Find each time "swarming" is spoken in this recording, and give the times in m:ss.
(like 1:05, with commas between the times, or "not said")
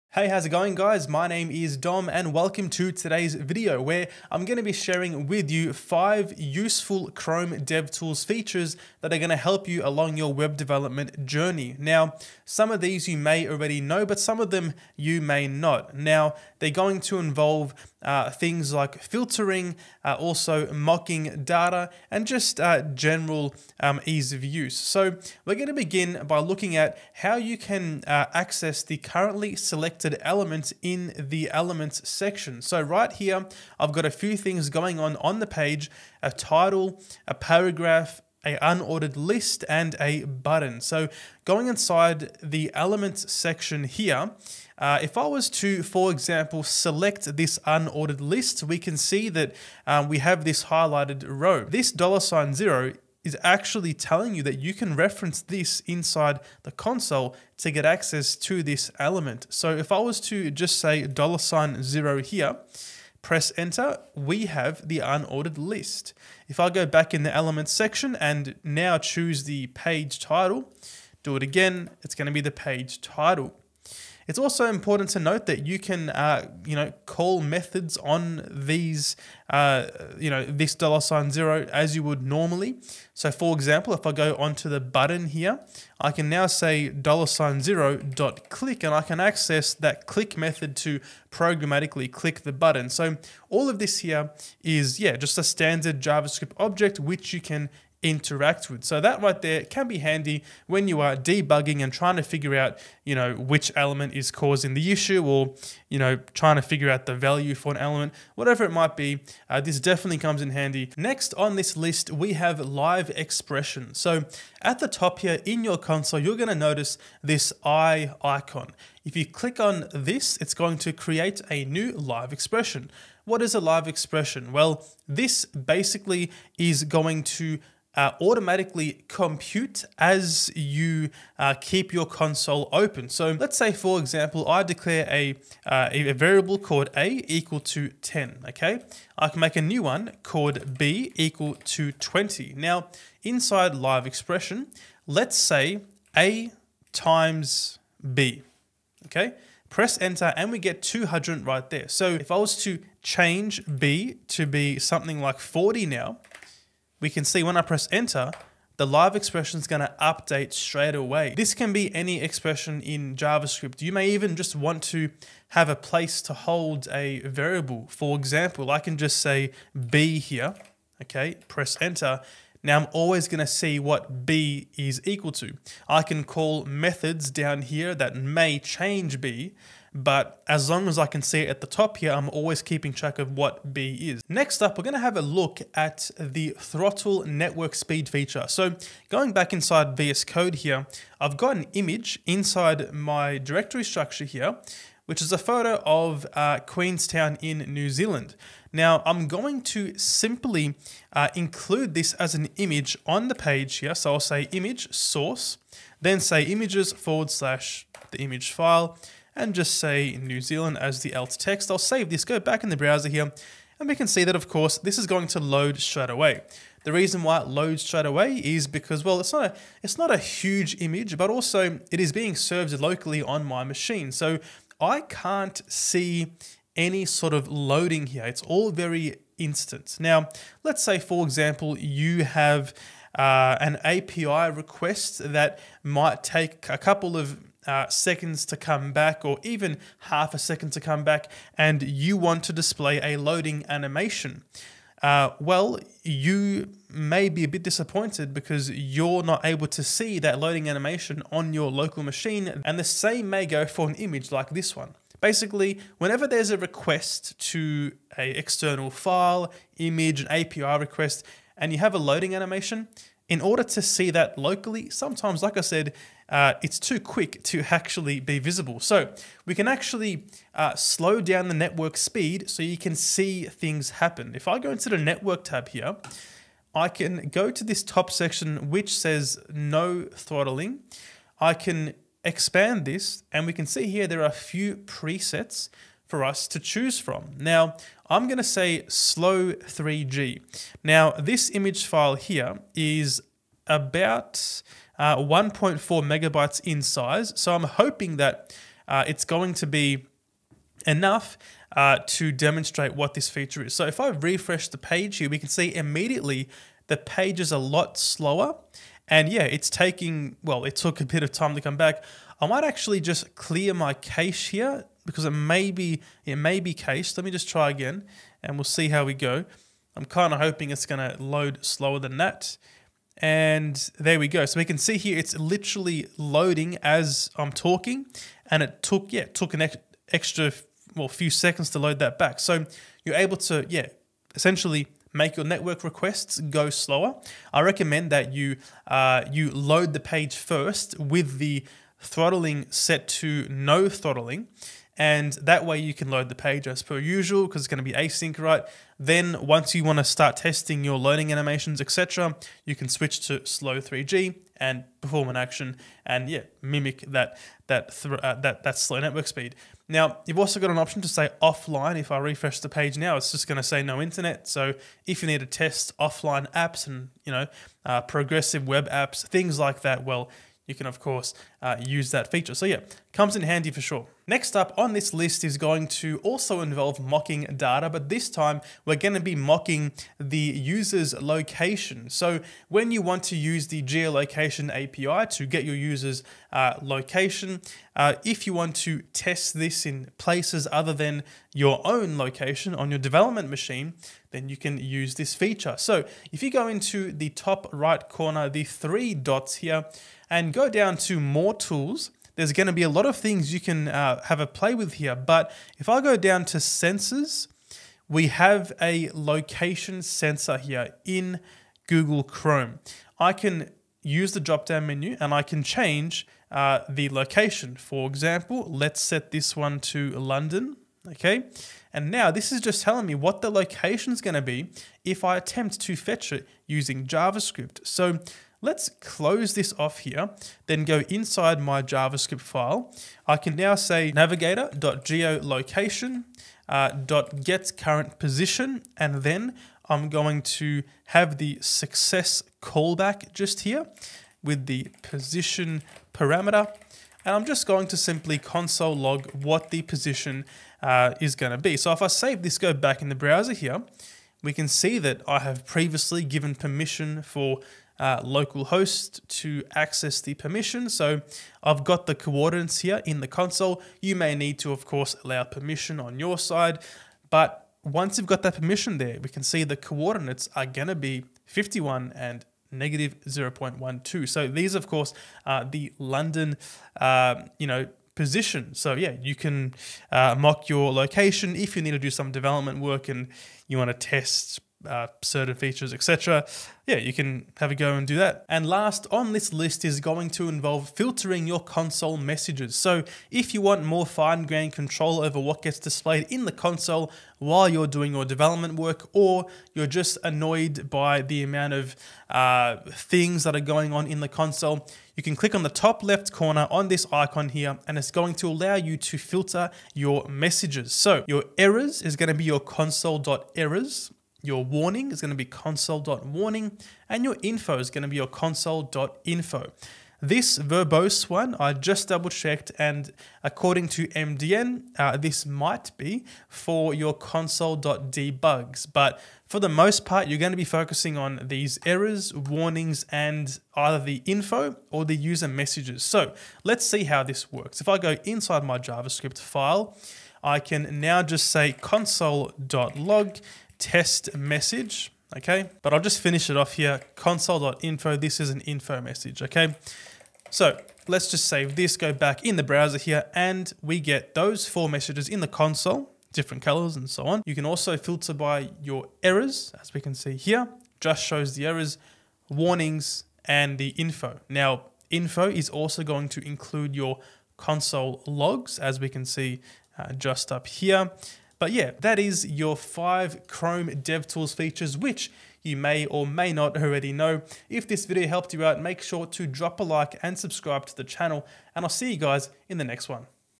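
not said.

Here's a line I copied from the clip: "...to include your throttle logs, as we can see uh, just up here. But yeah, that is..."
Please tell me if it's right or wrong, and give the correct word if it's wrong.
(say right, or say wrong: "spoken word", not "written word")
wrong: "console", not "throttle".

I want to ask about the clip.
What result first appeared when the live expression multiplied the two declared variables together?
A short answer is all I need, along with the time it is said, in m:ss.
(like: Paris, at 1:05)
200, at 2:30.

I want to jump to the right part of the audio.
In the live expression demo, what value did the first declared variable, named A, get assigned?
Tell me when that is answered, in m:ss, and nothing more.
2:17.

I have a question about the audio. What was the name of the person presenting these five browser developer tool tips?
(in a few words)
Dom.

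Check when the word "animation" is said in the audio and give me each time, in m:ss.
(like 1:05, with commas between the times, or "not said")
4:03, 4:10, 4:22, 5:51.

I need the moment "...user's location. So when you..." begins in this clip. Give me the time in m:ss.
6:20.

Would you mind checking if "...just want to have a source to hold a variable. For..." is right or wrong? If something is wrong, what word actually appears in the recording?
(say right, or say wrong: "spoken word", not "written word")
wrong: "place", not "source".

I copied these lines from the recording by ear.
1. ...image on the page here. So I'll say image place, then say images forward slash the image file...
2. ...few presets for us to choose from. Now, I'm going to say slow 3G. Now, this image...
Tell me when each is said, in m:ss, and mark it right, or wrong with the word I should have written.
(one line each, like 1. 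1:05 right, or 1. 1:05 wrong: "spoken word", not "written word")
1. 3:22 wrong: "source", not "place"
2. 4:44 right.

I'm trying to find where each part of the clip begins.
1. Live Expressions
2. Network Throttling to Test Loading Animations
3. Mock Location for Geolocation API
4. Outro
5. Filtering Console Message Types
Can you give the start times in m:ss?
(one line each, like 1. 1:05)
1. 1:50
2. 3:03
3. 6:13
4. 9:31
5. 8:08.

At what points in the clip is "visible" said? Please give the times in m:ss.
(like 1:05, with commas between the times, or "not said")
4:28.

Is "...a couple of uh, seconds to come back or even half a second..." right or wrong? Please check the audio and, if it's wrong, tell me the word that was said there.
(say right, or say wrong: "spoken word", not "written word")
right.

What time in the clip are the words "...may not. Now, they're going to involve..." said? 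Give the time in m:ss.
0:15.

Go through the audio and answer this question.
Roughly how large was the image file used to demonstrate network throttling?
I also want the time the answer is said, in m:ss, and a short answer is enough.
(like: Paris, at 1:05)
1.4 megabytes, at 4:55.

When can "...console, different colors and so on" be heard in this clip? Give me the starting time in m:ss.
9:15.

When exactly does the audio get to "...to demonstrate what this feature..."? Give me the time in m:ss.
5:02.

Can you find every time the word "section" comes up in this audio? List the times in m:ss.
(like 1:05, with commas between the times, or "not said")
0:32, 0:43, 1:07, 4:38.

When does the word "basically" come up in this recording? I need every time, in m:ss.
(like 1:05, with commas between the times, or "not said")
2:05, 4:15.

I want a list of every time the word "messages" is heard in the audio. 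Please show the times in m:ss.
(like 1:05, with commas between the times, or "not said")
8:12, 8:30, 8:55, 9:04, 9:09, 9:14.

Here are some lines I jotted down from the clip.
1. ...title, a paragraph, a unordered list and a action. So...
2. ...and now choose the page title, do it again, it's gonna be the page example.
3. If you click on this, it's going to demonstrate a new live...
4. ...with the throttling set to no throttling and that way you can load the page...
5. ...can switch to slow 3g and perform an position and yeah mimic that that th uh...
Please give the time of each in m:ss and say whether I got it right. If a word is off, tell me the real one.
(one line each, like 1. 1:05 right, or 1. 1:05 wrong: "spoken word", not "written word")
1. 0:36 wrong: "button", not "action"
2. 1:08 wrong: "title", not "example"
3. 1:59 wrong: "create", not "demonstrate"
4. 5:40 right
5. 5:52 wrong: "action", not "position".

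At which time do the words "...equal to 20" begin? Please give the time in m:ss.
2:21.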